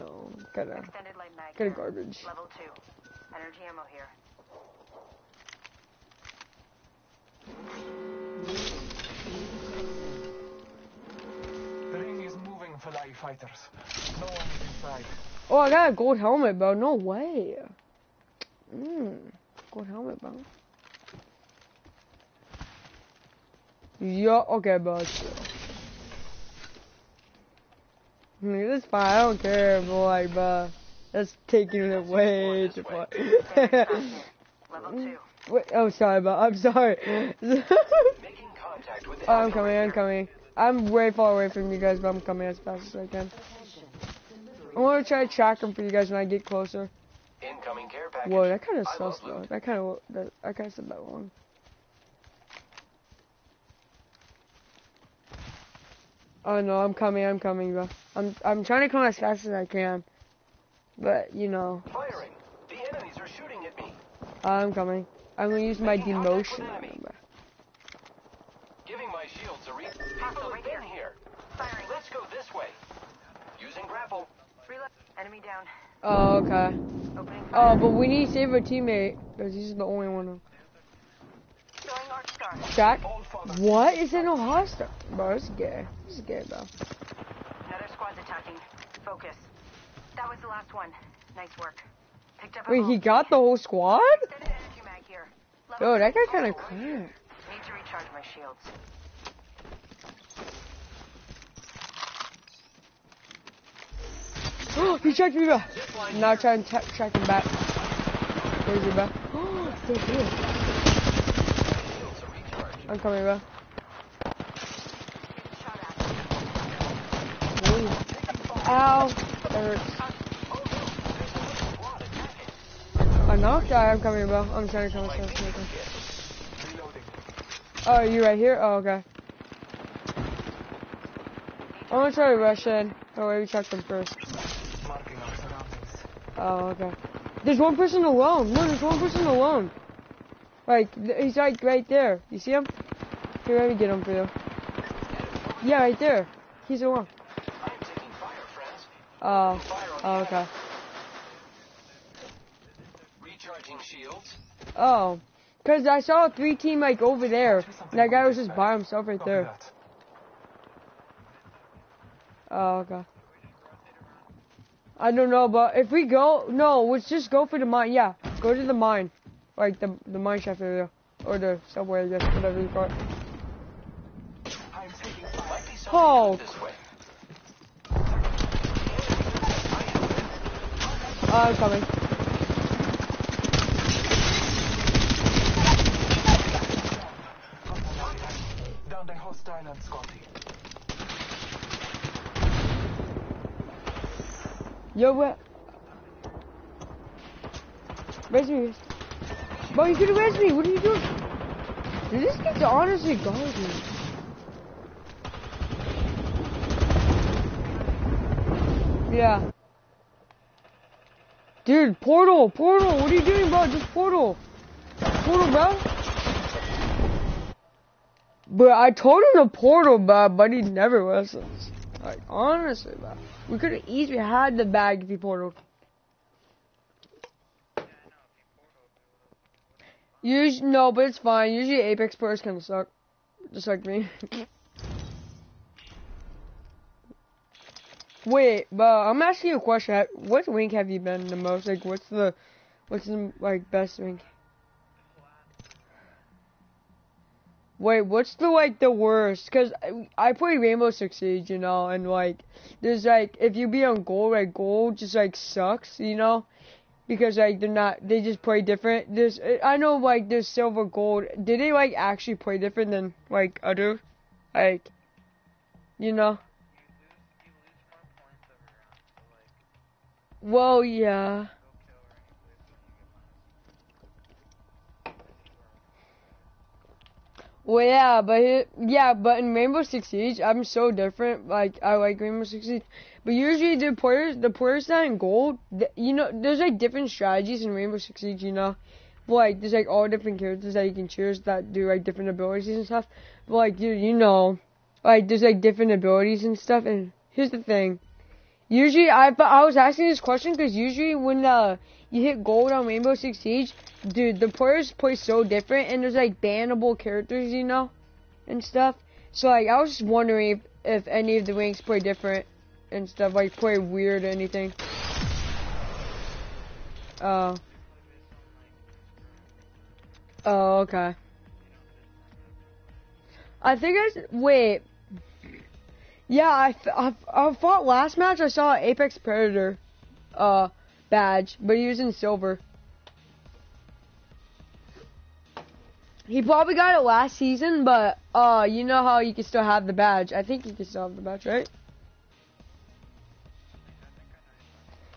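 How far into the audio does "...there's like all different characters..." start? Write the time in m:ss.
4:49.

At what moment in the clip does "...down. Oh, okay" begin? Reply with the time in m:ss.
1:15.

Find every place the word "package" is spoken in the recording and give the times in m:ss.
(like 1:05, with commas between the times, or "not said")
0:48.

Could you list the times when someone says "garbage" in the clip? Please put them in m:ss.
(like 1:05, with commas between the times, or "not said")
0:01, 3:23.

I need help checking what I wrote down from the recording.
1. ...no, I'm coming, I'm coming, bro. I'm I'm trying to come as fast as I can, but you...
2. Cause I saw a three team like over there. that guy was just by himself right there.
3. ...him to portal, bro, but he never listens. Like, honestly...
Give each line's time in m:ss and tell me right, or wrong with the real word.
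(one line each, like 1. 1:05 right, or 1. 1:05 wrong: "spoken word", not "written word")
1. 0:56 right
2. 2:35 right
3. 3:39 right.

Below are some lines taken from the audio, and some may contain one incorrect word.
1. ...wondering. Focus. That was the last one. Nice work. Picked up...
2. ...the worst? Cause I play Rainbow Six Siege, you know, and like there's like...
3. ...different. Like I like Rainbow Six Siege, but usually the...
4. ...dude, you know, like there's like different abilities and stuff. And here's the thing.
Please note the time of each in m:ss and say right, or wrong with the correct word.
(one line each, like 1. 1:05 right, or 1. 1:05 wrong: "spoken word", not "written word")
1. 1:28 wrong: "attacking", not "wondering"
2. 4:08 right
3. 4:40 right
4. 4:53 right.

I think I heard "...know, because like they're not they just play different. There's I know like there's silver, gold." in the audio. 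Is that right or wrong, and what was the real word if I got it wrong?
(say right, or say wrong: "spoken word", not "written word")
right.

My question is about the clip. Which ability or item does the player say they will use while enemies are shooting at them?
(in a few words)
Demotion.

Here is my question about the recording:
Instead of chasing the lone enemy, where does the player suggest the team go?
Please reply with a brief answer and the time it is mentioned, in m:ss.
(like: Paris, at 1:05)
The mine shaft, at 2:50.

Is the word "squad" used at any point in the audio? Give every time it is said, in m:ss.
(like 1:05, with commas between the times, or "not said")
1:27, 1:33.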